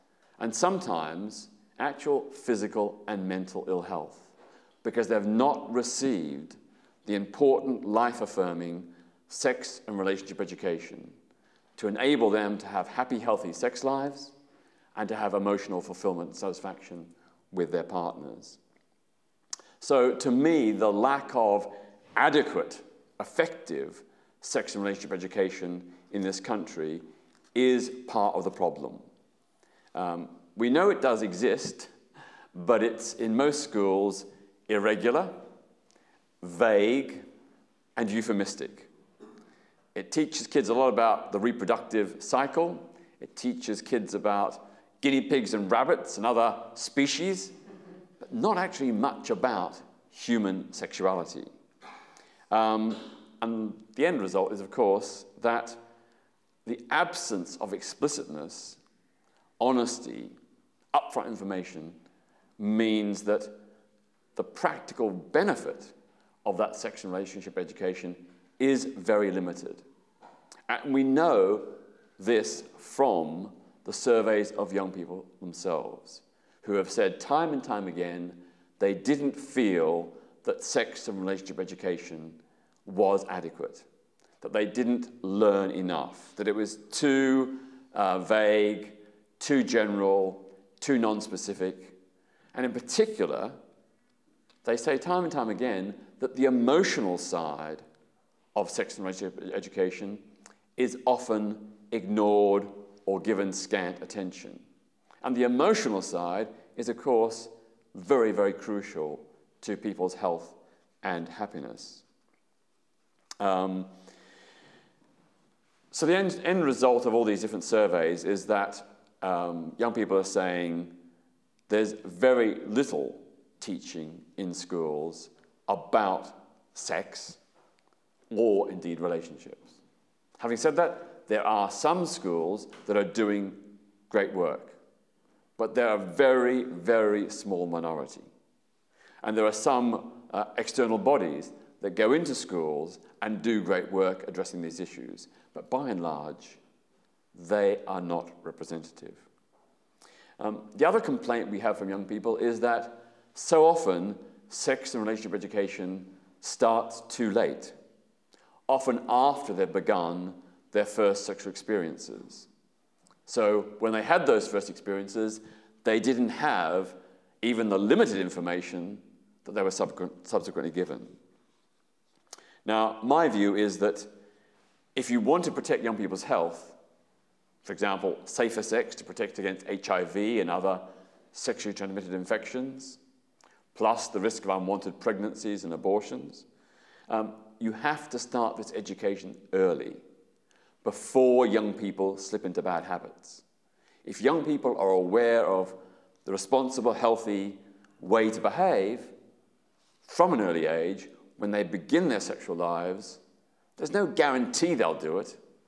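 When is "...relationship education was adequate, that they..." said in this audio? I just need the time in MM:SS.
01:21.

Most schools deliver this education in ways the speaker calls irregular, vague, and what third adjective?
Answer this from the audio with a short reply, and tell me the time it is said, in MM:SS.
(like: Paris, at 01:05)
euphemistic, at 00:38.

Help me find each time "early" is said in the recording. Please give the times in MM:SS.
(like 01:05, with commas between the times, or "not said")
03:09, 03:20.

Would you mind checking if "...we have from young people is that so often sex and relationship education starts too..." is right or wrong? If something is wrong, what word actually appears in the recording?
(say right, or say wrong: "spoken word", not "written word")
right.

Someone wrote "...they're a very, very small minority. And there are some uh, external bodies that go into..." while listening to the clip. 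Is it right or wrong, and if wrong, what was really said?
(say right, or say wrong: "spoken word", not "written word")
right.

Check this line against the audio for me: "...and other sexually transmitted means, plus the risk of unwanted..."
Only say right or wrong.
wrong.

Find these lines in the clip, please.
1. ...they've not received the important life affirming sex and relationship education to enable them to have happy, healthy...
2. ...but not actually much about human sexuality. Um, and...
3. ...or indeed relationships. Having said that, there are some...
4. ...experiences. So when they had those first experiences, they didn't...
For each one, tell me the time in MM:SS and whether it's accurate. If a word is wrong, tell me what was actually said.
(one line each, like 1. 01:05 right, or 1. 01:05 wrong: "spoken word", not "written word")
1. 00:05 right
2. 00:48 right
3. 02:08 right
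4. 02:41 right.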